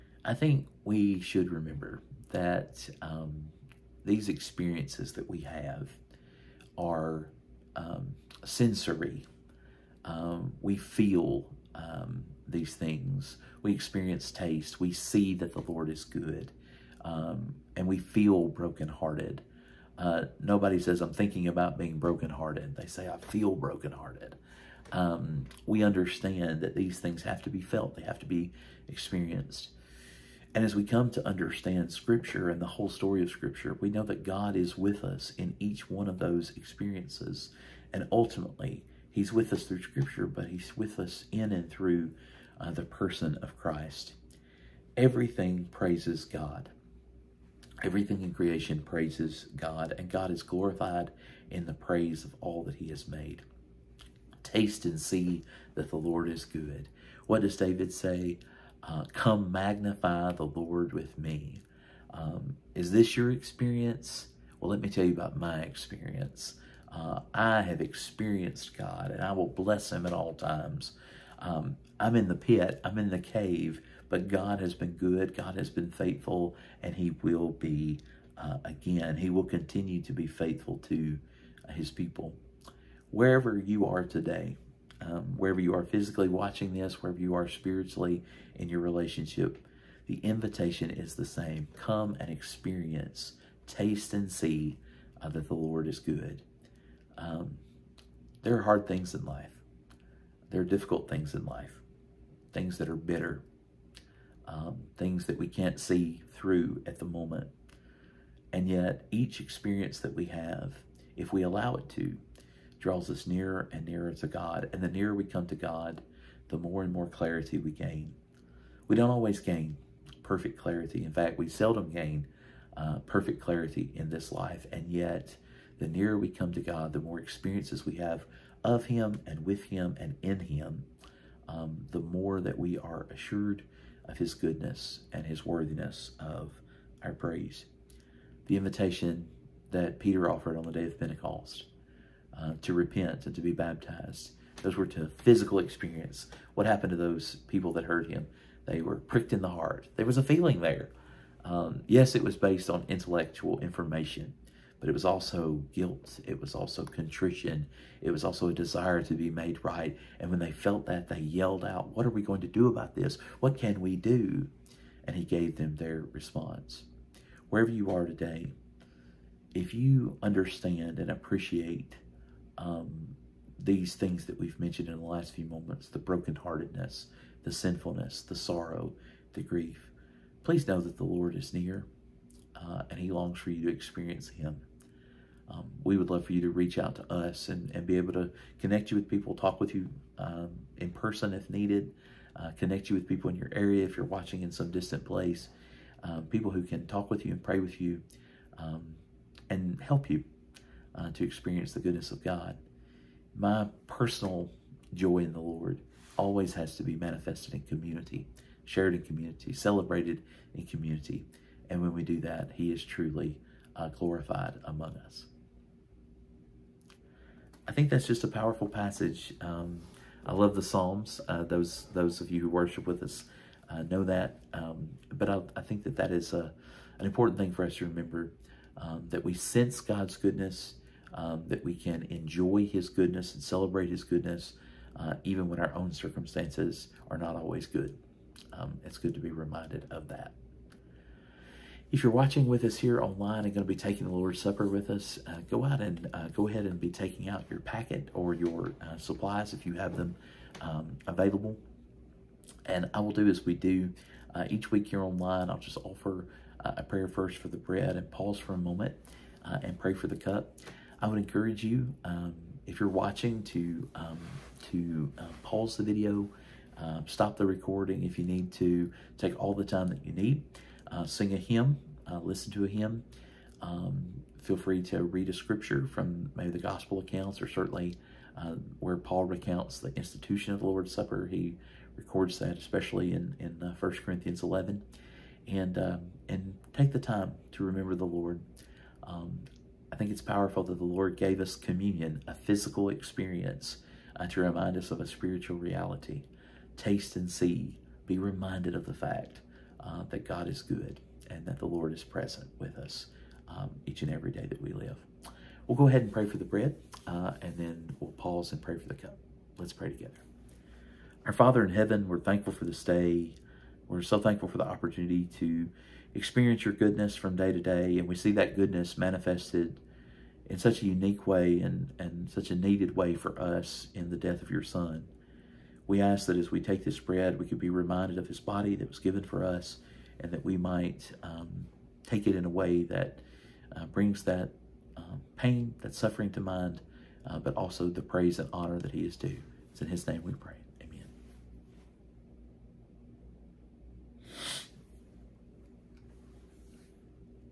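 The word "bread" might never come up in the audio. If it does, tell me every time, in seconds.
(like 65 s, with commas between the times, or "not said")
257 s, 306 s, 326 s.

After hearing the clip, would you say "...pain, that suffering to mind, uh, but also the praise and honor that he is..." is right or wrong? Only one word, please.
right.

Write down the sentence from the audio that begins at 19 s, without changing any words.
Uh, nobody says, I'm thinking about being brokenhearted.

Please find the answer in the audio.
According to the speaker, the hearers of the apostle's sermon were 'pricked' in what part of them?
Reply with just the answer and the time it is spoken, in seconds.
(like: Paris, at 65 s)
The heart, at 149 s.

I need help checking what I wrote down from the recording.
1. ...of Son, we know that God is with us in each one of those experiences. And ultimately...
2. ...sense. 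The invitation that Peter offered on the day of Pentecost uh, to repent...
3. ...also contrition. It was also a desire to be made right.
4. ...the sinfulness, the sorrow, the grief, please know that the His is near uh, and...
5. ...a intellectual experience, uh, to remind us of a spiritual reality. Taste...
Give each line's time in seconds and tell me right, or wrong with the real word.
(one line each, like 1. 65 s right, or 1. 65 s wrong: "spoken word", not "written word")
1. 33 s wrong: "Scripture", not "Son"
2. 137 s wrong: "praise", not "sense"
3. 156 s right
4. 177 s wrong: "Lord", not "His"
5. 292 s wrong: "physical", not "intellectual".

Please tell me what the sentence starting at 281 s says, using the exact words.
He records that, especially in, in uh, 1 Corinthians 11.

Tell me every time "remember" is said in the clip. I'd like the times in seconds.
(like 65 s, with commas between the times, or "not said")
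1 s, 227 s, 287 s.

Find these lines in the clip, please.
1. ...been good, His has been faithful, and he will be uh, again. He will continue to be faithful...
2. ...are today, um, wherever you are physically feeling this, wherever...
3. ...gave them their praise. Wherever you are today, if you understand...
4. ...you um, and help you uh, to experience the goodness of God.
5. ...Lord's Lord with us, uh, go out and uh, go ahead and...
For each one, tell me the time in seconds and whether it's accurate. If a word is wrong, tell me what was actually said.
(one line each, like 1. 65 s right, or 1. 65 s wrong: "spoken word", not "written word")
1. 74 s wrong: "God", not "His"
2. 83 s wrong: "watching", not "feeling"
3. 165 s wrong: "response", not "praise"
4. 197 s right
5. 244 s wrong: "Supper", not "Lord".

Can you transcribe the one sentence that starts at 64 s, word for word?
Well, let me tell you about my experience.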